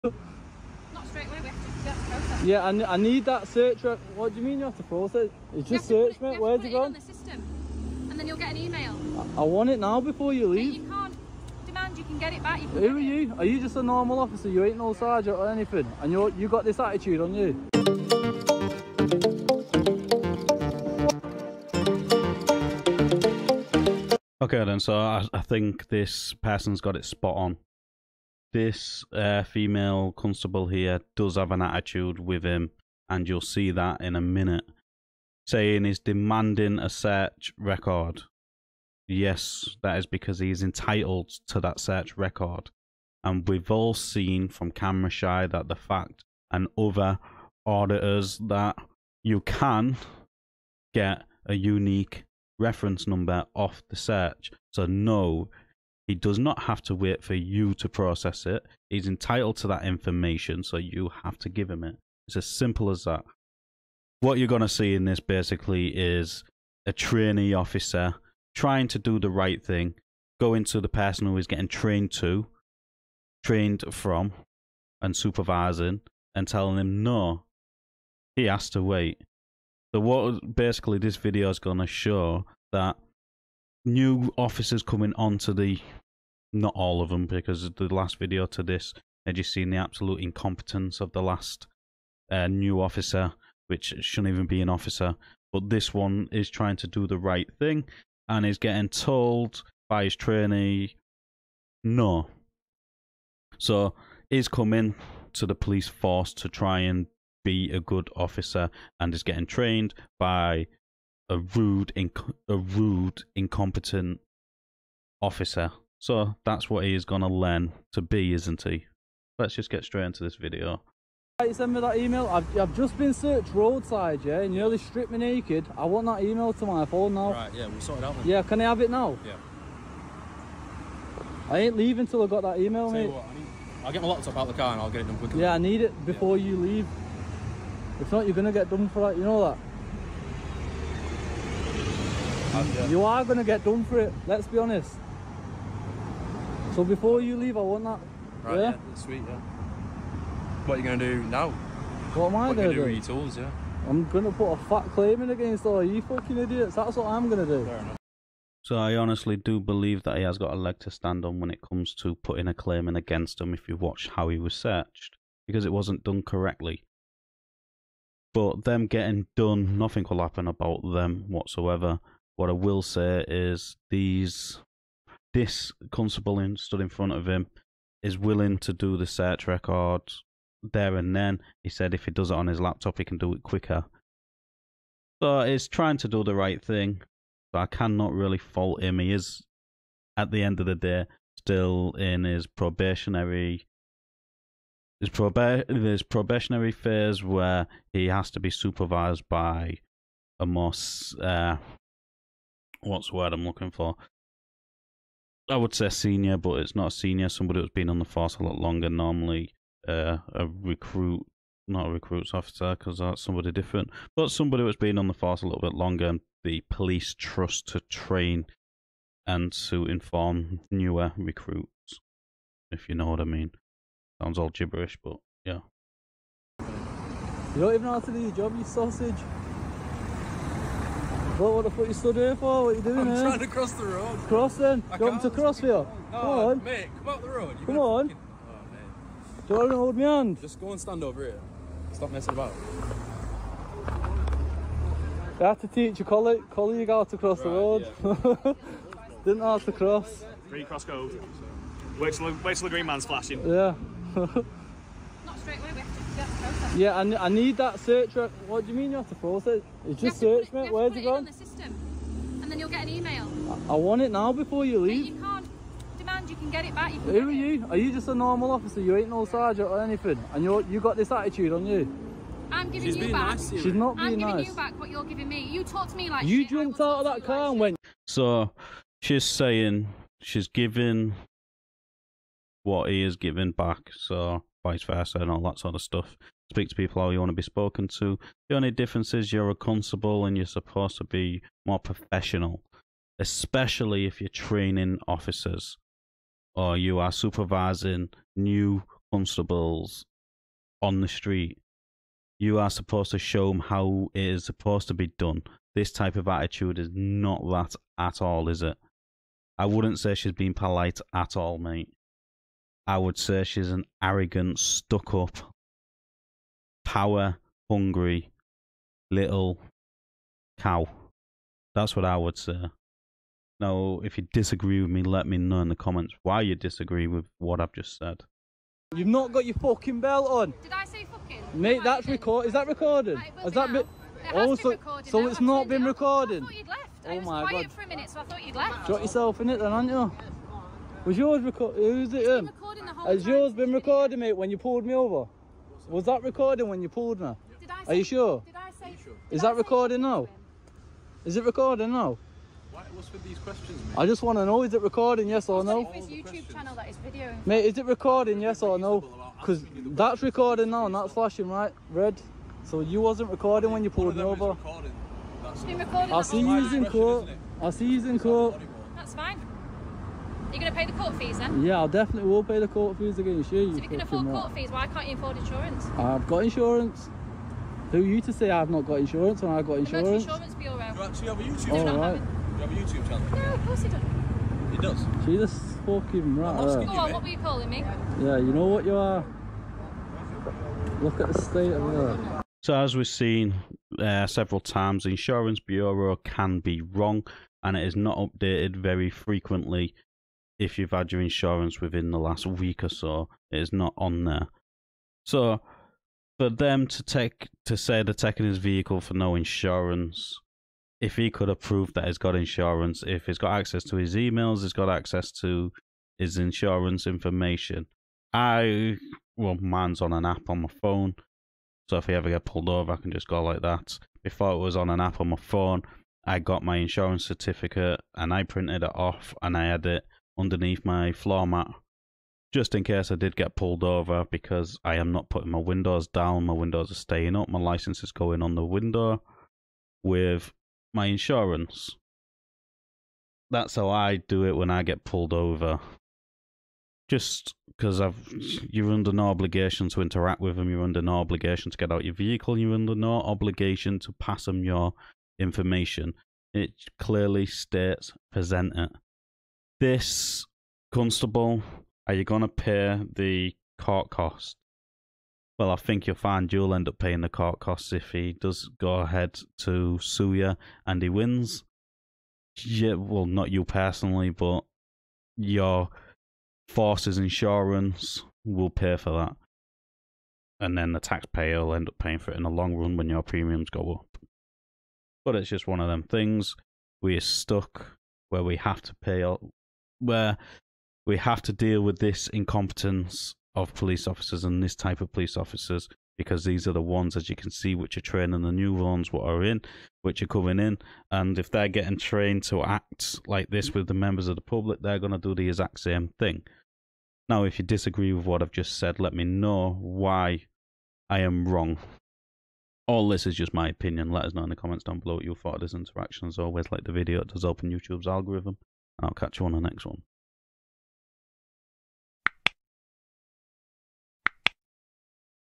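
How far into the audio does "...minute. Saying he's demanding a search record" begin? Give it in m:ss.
0:34.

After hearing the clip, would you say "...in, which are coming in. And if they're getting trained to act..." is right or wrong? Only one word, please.
right.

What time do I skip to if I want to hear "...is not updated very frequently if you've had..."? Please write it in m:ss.
6:37.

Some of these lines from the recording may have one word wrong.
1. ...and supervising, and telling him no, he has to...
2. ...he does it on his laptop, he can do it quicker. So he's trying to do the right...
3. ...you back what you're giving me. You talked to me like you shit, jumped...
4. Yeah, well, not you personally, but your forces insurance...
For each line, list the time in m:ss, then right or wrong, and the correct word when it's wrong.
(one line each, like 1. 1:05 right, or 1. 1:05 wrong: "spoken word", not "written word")
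1. 1:15 right
2. 3:02 right
3. 4:34 right
4. 7:52 right.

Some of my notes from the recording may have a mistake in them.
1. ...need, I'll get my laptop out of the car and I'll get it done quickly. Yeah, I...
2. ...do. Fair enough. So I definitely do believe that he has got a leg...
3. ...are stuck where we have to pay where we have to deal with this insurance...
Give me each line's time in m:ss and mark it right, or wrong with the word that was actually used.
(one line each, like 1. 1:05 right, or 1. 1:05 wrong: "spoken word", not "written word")
1. 2:13 right
2. 2:37 wrong: "honestly", not "definitely"
3. 8:07 wrong: "incompetence", not "insurance".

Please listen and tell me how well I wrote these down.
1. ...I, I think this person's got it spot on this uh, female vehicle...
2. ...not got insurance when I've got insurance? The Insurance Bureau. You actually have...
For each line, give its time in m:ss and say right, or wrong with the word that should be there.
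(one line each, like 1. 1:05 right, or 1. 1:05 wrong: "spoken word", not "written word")
1. 0:24 wrong: "constable", not "vehicle"
2. 6:18 right.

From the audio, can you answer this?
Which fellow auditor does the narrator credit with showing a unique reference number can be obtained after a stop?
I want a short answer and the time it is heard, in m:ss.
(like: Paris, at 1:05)
Camera Shy, at 0:44.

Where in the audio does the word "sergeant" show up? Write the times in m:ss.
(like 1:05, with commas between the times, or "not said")
0:14, 4:29.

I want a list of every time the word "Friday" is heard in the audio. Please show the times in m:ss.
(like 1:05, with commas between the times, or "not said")
not said.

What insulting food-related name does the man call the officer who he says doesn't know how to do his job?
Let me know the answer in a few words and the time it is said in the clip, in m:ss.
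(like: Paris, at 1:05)
Sausage, at 3:48.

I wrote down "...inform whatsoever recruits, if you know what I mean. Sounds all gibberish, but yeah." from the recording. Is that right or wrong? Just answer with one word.
wrong.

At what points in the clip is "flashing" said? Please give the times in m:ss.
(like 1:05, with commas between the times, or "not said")
4:13, 6:01.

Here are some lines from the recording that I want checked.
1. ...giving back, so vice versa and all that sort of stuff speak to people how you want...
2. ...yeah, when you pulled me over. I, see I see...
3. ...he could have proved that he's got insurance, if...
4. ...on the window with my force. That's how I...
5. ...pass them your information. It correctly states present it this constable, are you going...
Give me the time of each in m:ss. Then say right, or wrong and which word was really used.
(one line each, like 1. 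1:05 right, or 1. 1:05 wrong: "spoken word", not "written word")
1. 4:43 right
2. 6:03 right
3. 6:51 right
4. 7:18 wrong: "insurance", not "force"
5. 7:34 wrong: "clearly", not "correctly".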